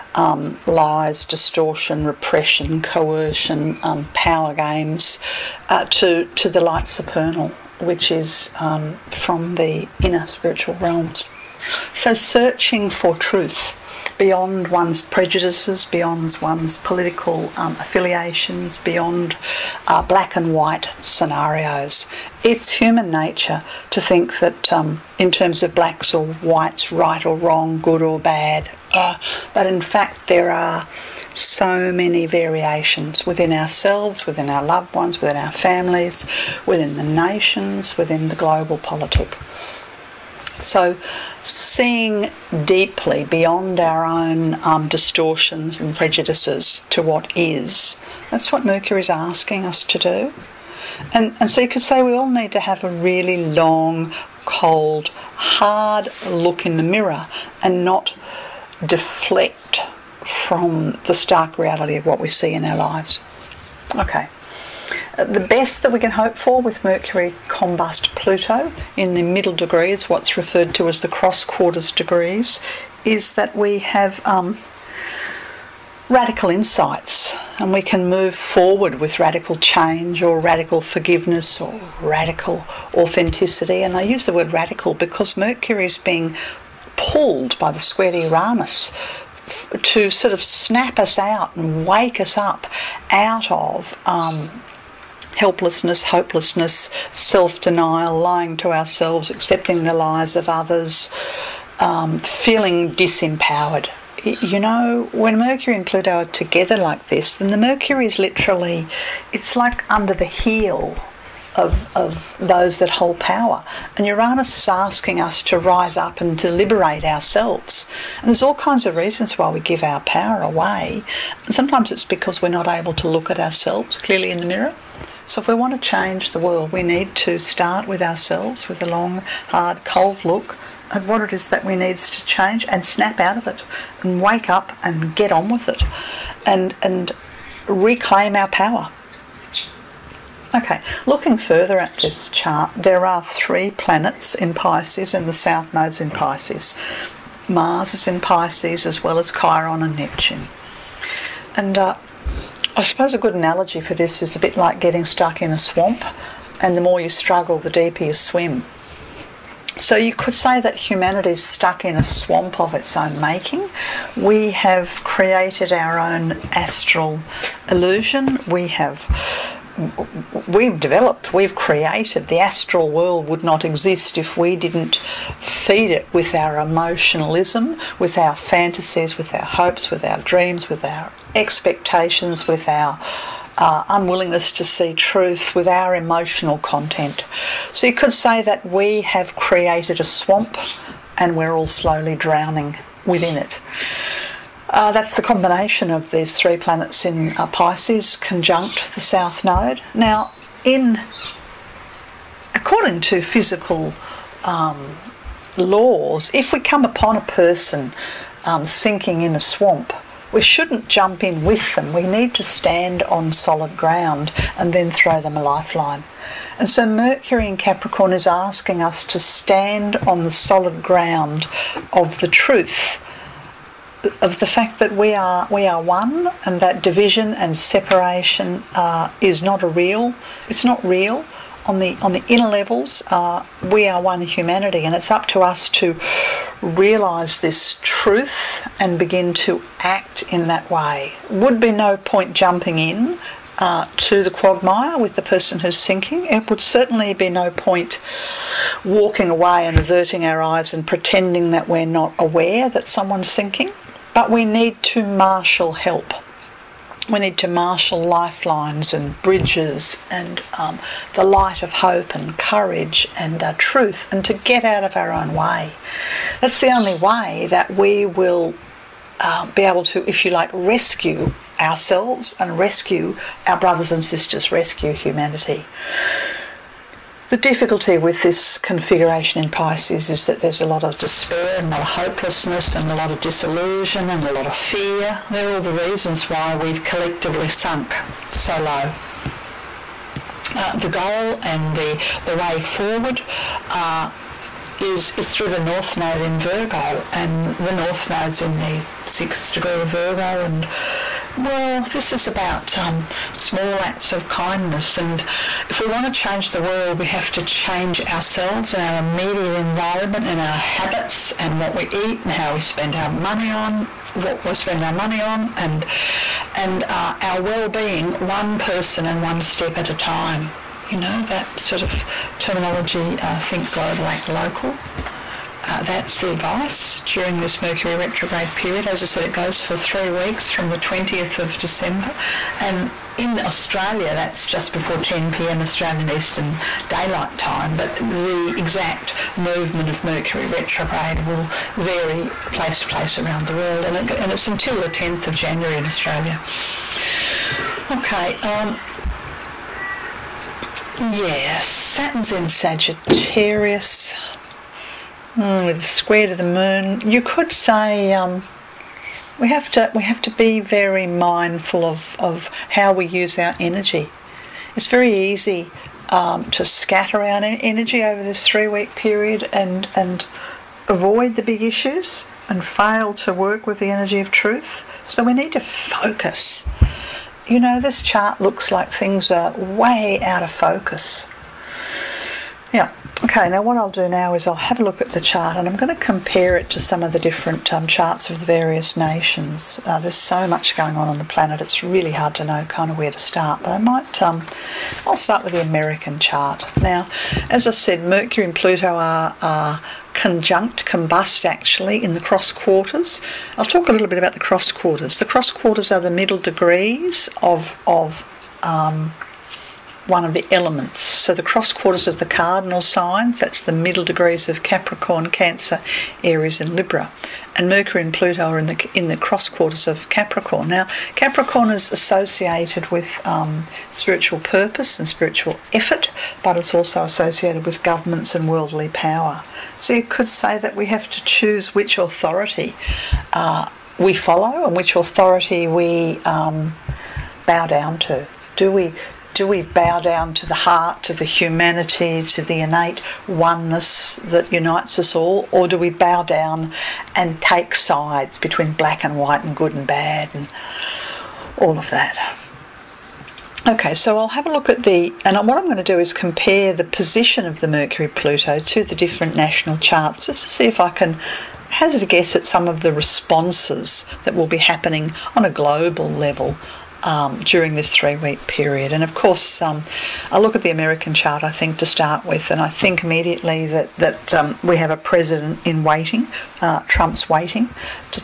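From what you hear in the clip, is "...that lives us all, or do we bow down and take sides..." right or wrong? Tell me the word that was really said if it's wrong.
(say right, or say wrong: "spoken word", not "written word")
wrong: "unites", not "lives".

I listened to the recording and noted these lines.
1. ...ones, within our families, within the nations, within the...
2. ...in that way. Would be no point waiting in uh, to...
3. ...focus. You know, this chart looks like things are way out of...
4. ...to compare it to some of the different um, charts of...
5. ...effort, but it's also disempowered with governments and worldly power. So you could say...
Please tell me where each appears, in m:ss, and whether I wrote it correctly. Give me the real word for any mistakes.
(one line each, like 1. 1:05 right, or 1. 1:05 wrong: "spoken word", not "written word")
1. 0:34 right
2. 4:00 wrong: "jumping", not "waiting"
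3. 6:15 right
4. 6:25 right
5. 7:05 wrong: "associated", not "disempowered".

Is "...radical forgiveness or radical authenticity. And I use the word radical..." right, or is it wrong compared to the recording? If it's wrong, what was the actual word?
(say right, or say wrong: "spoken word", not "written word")
right.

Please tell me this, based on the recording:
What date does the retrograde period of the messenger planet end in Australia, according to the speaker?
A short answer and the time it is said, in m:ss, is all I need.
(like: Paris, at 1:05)
10th of January, at 5:44.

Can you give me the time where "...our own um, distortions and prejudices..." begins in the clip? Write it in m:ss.
0:43.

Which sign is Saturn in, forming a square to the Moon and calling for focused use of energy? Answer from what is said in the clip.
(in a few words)
Sagittarius.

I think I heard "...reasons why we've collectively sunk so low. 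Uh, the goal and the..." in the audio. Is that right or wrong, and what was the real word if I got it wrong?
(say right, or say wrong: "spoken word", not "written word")
right.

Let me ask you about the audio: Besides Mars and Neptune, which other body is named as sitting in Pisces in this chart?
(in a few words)
Chiron.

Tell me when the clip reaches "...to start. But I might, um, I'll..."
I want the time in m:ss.
6:33.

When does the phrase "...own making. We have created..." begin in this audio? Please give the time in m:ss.
2:42.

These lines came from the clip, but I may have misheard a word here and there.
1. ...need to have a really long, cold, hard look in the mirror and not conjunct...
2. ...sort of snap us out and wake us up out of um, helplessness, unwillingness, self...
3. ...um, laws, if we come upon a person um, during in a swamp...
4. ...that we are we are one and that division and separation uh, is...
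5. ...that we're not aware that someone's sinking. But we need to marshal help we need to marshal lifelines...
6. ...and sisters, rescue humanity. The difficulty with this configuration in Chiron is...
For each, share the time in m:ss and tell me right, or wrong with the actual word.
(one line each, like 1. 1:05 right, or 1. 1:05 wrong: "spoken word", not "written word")
1. 0:52 wrong: "deflect", not "conjunct"
2. 1:30 wrong: "hopelessness", not "unwillingness"
3. 3:24 wrong: "sinking", not "during"
4. 3:44 right
5. 4:11 right
6. 4:33 wrong: "Pisces", not "Chiron".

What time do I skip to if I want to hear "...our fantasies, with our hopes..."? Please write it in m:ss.
2:58.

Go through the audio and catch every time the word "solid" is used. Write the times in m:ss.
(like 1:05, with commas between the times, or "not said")
3:33, 3:40.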